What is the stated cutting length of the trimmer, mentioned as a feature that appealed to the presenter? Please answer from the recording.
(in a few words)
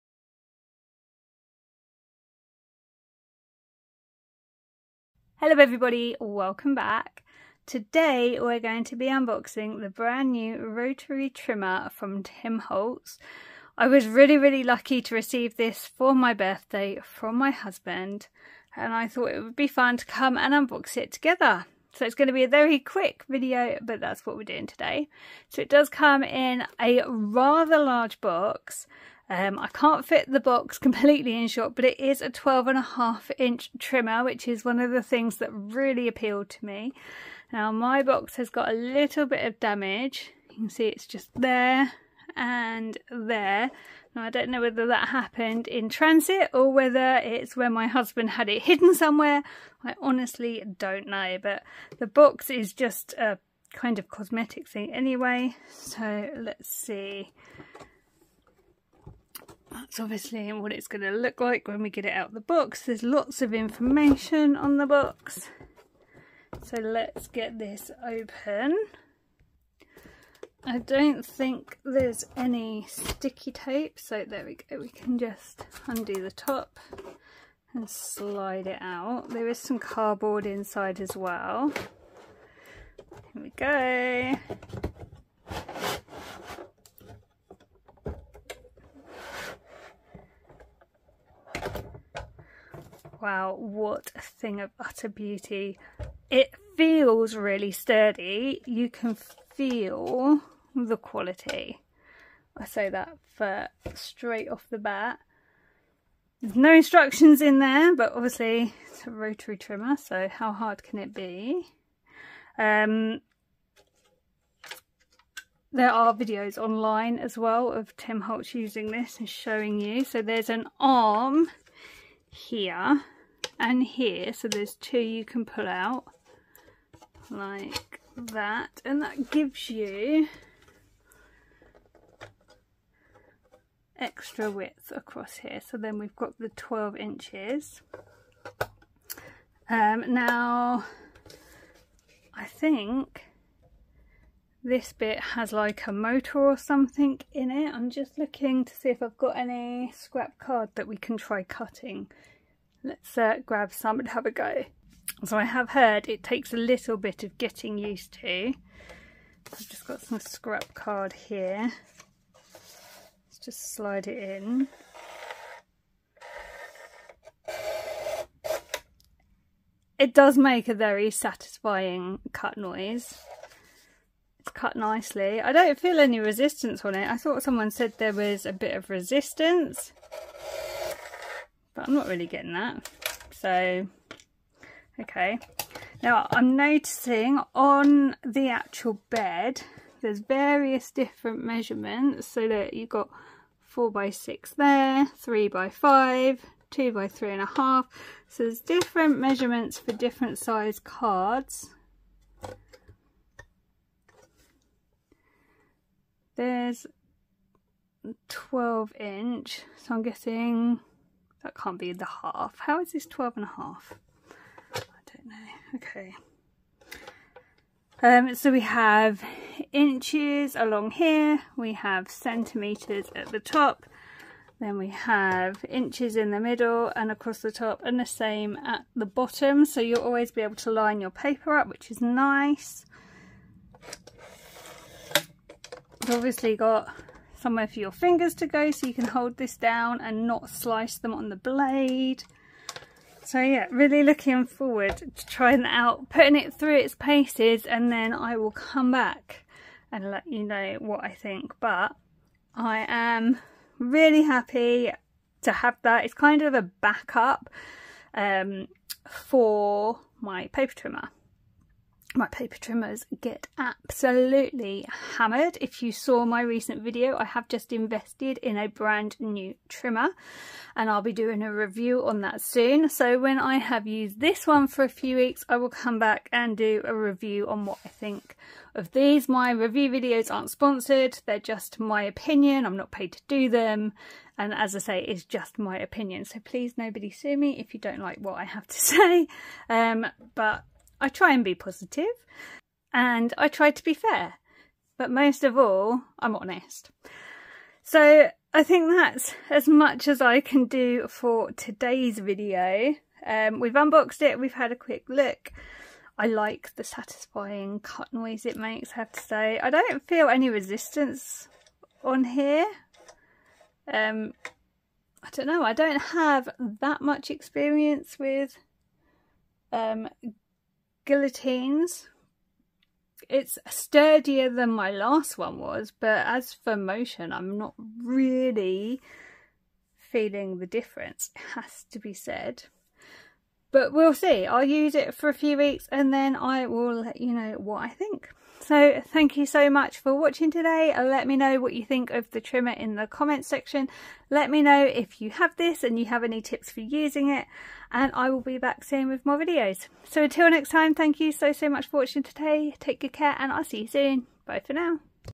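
12.5 inches.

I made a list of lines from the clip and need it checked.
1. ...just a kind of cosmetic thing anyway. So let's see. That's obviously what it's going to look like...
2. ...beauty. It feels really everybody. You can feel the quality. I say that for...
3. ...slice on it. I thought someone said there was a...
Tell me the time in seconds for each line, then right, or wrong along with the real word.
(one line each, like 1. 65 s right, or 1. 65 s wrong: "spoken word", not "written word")
1. 52 s right
2. 95 s wrong: "sturdy", not "everybody"
3. 176 s wrong: "resistance", not "slice".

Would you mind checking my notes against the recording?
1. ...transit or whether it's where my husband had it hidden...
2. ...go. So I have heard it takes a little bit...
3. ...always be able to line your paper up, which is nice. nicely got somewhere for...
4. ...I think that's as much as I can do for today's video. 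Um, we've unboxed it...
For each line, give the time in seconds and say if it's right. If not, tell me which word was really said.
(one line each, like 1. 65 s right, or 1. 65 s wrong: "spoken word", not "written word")
1. 45 s right
2. 154 s right
3. 230 s wrong: "obviously", not "nicely"
4. 298 s right.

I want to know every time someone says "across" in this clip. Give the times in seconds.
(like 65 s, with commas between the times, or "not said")
134 s, 227 s.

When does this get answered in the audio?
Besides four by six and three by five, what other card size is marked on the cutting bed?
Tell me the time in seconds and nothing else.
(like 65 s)
196 s.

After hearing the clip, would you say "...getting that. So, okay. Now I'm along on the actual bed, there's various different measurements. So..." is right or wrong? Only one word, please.
wrong.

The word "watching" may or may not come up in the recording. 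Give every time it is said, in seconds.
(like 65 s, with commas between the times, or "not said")
340 s, 351 s.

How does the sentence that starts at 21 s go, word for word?
So it's going to be a very quick video but that's what we're doing today.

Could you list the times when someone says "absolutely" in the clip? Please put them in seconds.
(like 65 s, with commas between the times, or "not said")
263 s.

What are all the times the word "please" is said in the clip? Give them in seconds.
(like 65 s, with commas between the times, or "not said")
286 s.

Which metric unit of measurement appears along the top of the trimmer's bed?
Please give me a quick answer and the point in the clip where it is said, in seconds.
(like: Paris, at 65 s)
centimetres, at 222 s.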